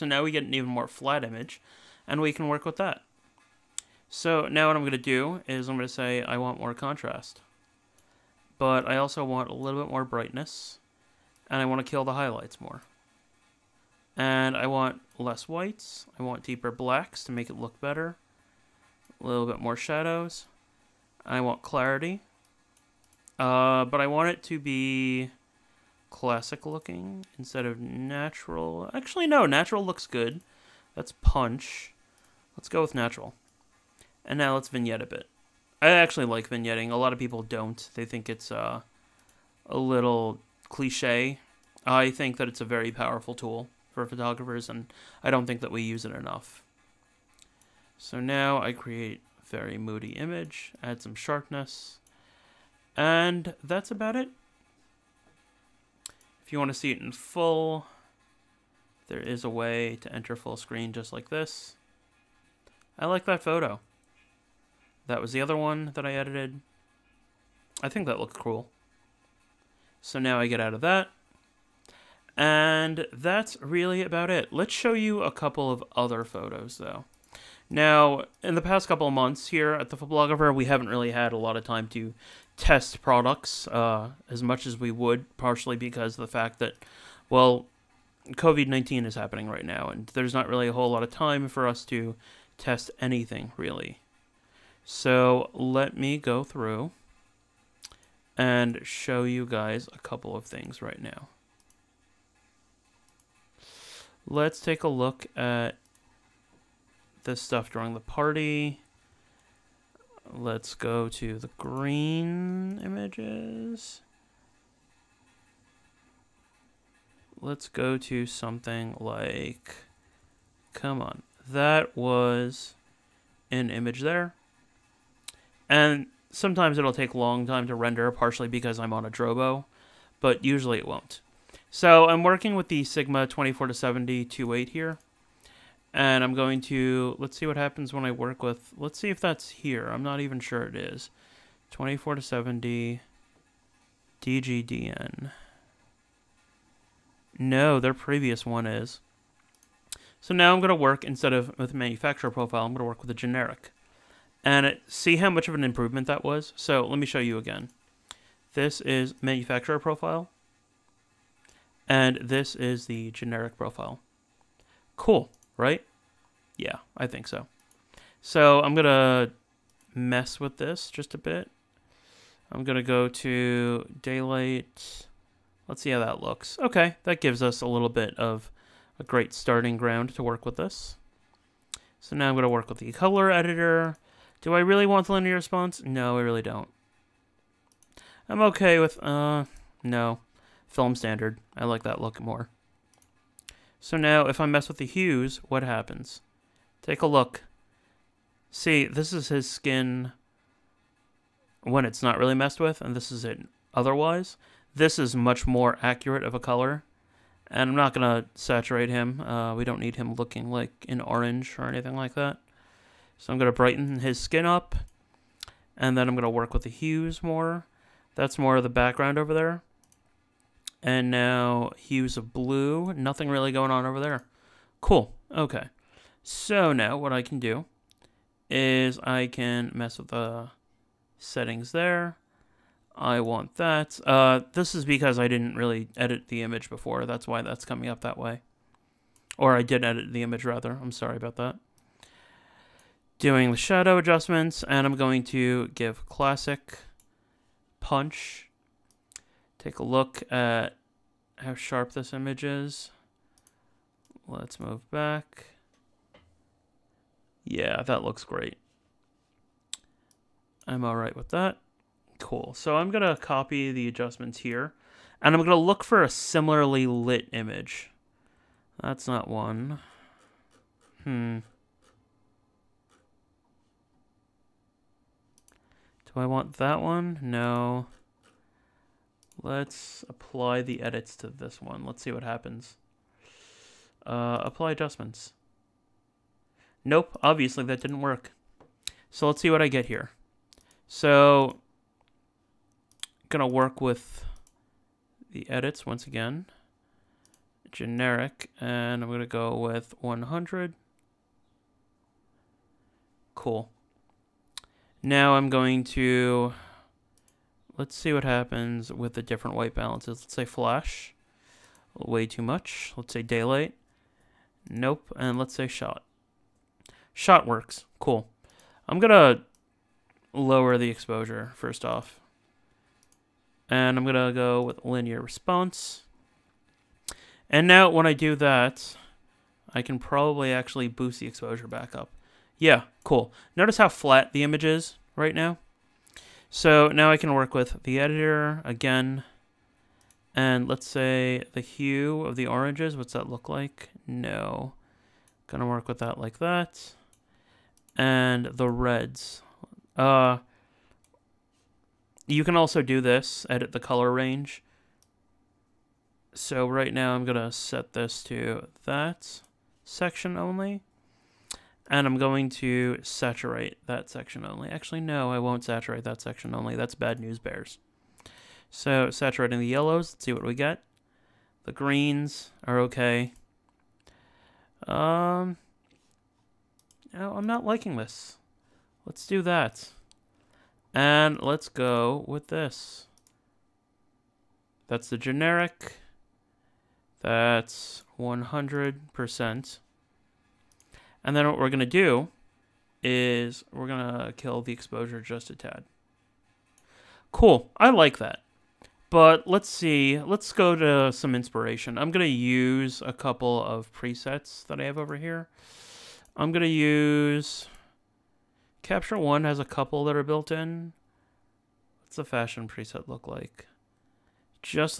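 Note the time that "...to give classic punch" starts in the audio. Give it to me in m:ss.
4:05.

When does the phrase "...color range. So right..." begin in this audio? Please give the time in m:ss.
5:53.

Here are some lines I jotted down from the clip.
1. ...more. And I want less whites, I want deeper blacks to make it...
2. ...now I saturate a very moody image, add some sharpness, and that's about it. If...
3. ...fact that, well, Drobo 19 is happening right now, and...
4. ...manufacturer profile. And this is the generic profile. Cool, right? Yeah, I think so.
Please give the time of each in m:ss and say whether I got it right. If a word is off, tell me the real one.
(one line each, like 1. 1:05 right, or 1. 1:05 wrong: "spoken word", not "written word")
1. 0:12 right
2. 0:48 wrong: "create", not "saturate"
3. 1:26 wrong: "COVID", not "Drobo"
4. 2:39 right.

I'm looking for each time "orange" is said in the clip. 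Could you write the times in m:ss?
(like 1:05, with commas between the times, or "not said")
3:31, 5:42.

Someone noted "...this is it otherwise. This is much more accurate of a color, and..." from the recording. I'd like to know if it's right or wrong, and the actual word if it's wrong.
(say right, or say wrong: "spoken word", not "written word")
right.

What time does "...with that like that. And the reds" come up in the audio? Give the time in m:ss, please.
5:45.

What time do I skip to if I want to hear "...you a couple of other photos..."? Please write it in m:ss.
1:14.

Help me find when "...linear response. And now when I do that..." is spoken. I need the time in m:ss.
5:24.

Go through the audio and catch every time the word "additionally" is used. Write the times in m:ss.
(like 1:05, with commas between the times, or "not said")
not said.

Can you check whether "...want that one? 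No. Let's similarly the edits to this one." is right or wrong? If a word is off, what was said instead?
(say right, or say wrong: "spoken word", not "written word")
wrong: "apply", not "similarly".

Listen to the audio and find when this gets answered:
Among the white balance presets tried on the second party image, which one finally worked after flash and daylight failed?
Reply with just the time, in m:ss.
5:17.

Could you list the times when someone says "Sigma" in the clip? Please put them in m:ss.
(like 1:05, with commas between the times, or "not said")
2:12.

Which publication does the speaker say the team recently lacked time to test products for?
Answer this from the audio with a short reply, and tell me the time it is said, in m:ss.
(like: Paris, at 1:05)
The Phoblographer, at 1:19.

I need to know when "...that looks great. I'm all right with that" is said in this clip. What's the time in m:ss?
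4:17.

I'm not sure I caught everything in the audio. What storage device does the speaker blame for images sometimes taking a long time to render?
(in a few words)
Drobo.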